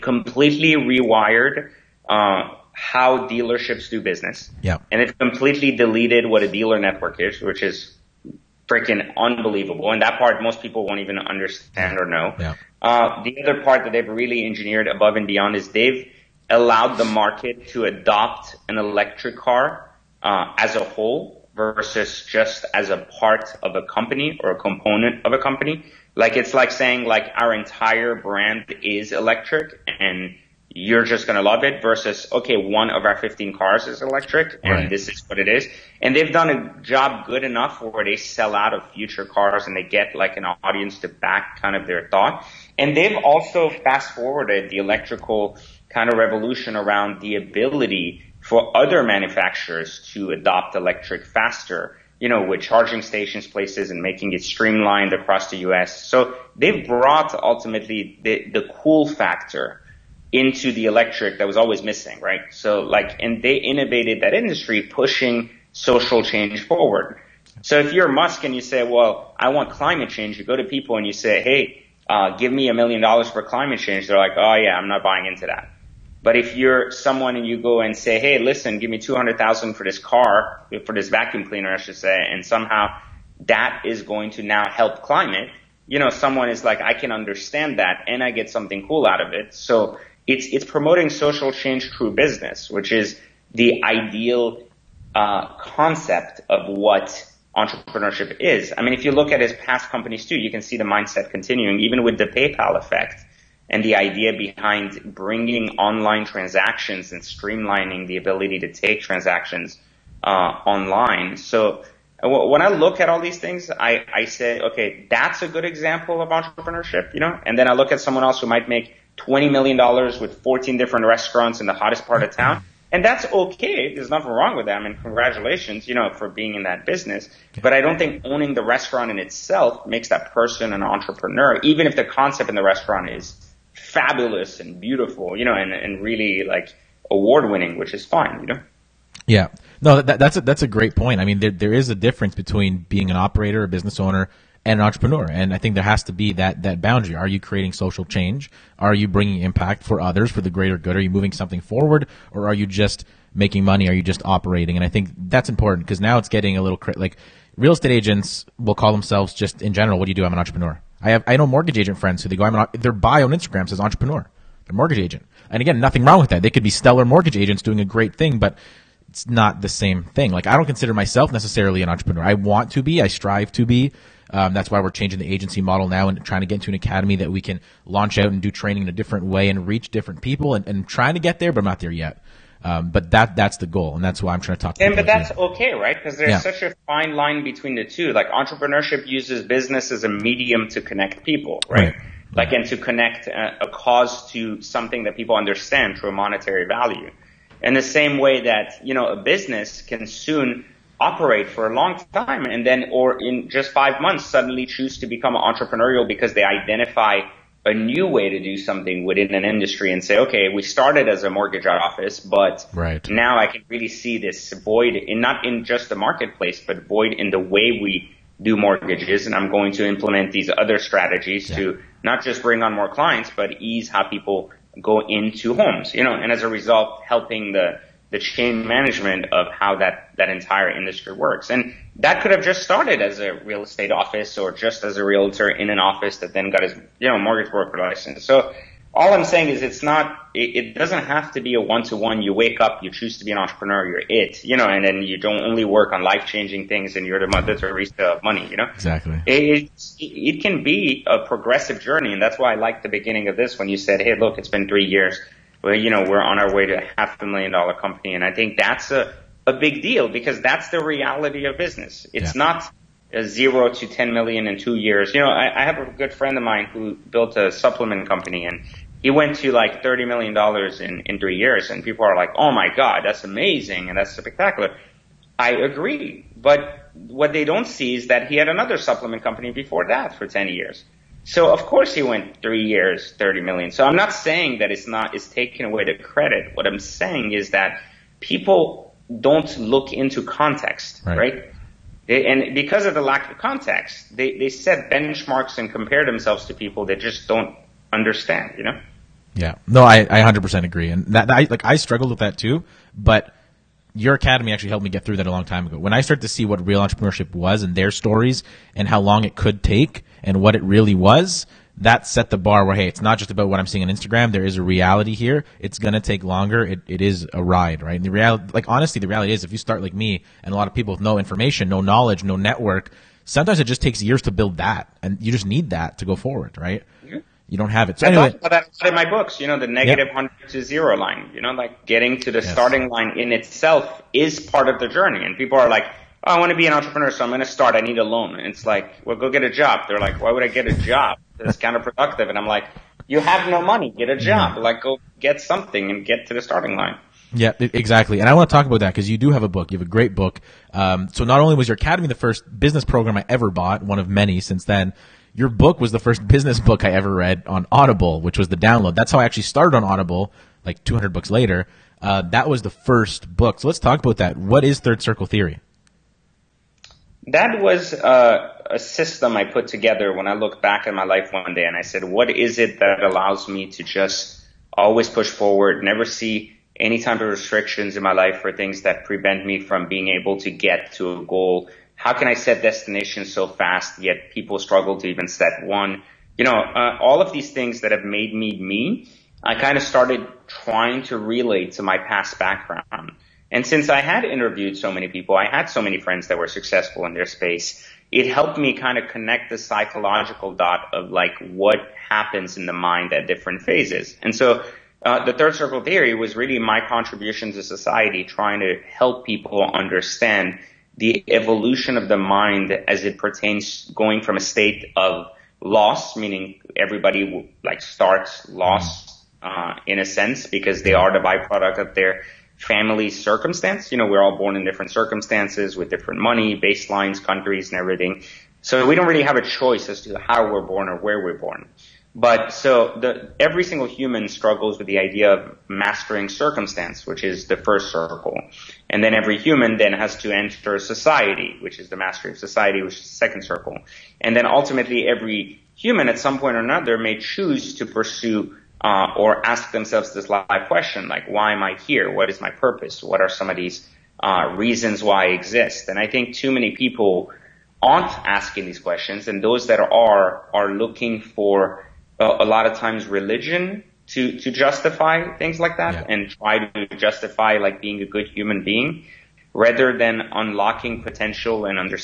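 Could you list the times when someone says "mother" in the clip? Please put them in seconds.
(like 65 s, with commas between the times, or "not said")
247 s.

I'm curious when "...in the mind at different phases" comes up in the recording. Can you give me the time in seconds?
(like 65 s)
402 s.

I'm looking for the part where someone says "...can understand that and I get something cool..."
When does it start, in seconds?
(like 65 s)
86 s.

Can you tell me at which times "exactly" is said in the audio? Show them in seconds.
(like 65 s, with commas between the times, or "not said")
248 s, 347 s.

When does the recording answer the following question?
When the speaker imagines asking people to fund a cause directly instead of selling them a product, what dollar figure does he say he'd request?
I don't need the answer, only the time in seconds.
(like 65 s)
72 s.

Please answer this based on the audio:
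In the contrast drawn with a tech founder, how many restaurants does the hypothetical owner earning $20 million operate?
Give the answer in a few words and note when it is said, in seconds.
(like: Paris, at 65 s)
14, at 120 s.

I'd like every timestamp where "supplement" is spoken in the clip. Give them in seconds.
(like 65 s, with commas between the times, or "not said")
267 s, 278 s.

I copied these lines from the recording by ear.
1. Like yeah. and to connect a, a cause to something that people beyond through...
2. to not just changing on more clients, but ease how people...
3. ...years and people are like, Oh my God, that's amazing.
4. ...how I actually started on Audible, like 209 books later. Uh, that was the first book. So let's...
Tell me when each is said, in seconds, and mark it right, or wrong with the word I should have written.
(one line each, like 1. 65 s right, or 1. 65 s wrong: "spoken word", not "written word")
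1. 192 s wrong: "understand", not "beyond"
2. 221 s wrong: "bring", not "changing"
3. 271 s right
4. 359 s wrong: "200", not "209".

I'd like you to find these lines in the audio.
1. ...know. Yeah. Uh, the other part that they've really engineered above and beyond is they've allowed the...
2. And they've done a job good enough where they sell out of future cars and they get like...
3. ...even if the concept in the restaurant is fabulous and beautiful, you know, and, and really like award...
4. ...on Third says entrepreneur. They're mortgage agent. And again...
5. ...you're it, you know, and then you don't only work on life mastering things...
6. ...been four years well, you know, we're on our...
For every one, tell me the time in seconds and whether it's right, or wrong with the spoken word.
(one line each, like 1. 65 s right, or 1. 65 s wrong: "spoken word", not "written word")
1. 12 s right
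2. 36 s right
3. 131 s right
4. 163 s wrong: "Instagram", not "Third"
5. 243 s wrong: "changing", not "mastering"
6. 254 s wrong: "three", not "four".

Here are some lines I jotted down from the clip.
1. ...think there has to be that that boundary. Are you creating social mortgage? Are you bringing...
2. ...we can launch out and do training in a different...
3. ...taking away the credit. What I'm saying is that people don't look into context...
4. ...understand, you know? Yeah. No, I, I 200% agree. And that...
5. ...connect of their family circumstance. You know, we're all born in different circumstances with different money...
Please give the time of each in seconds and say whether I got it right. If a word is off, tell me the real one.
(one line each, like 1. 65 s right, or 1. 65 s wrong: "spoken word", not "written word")
1. 145 s wrong: "change", not "mortgage"
2. 177 s right
3. 285 s right
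4. 297 s wrong: "100", not "200"
5. 421 s wrong: "byproduct", not "connect".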